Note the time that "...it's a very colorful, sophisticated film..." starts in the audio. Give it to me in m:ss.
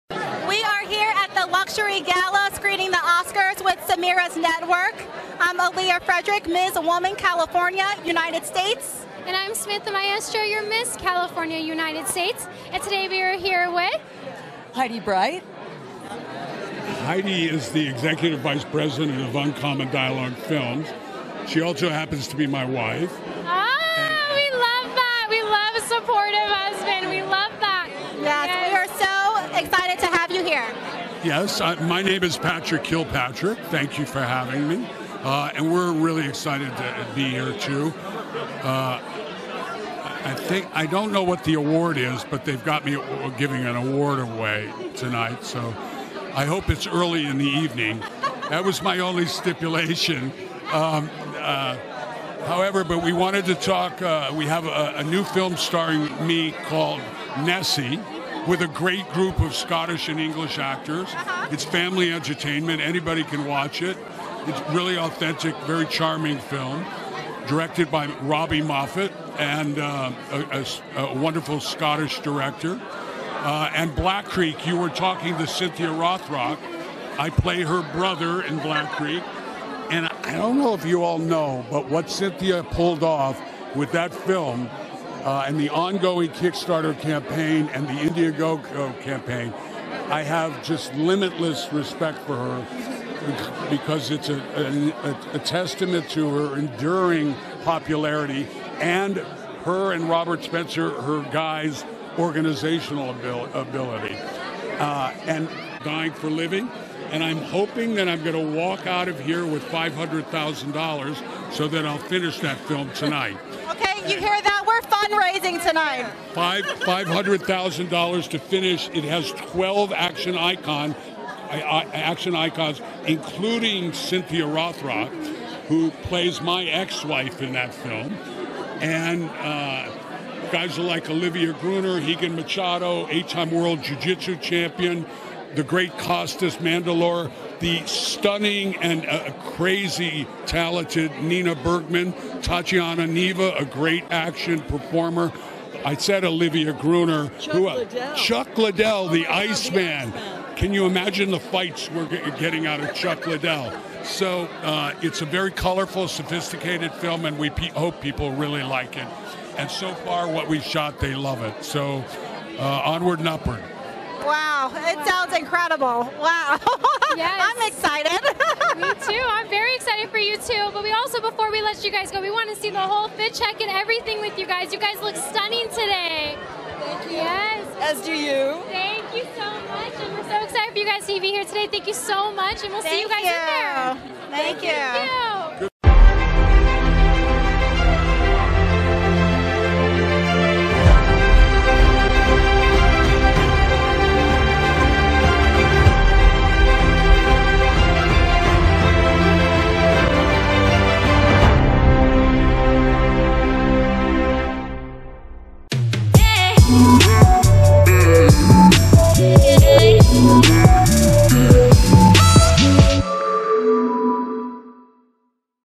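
2:35.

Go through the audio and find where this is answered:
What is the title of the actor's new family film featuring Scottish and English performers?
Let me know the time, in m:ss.
0:57.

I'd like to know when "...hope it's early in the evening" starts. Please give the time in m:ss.
0:46.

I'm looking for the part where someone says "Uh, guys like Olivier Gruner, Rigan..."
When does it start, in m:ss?
2:09.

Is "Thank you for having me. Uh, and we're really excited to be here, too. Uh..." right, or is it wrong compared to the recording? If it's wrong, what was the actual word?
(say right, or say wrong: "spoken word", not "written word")
right.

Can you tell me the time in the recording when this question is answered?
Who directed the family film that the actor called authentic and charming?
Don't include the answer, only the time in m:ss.
1:08.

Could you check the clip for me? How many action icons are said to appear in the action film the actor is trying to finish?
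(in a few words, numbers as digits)
12.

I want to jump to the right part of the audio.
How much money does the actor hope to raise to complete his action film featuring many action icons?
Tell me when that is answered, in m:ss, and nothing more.
1:49.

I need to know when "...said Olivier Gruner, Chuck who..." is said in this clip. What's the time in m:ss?
2:25.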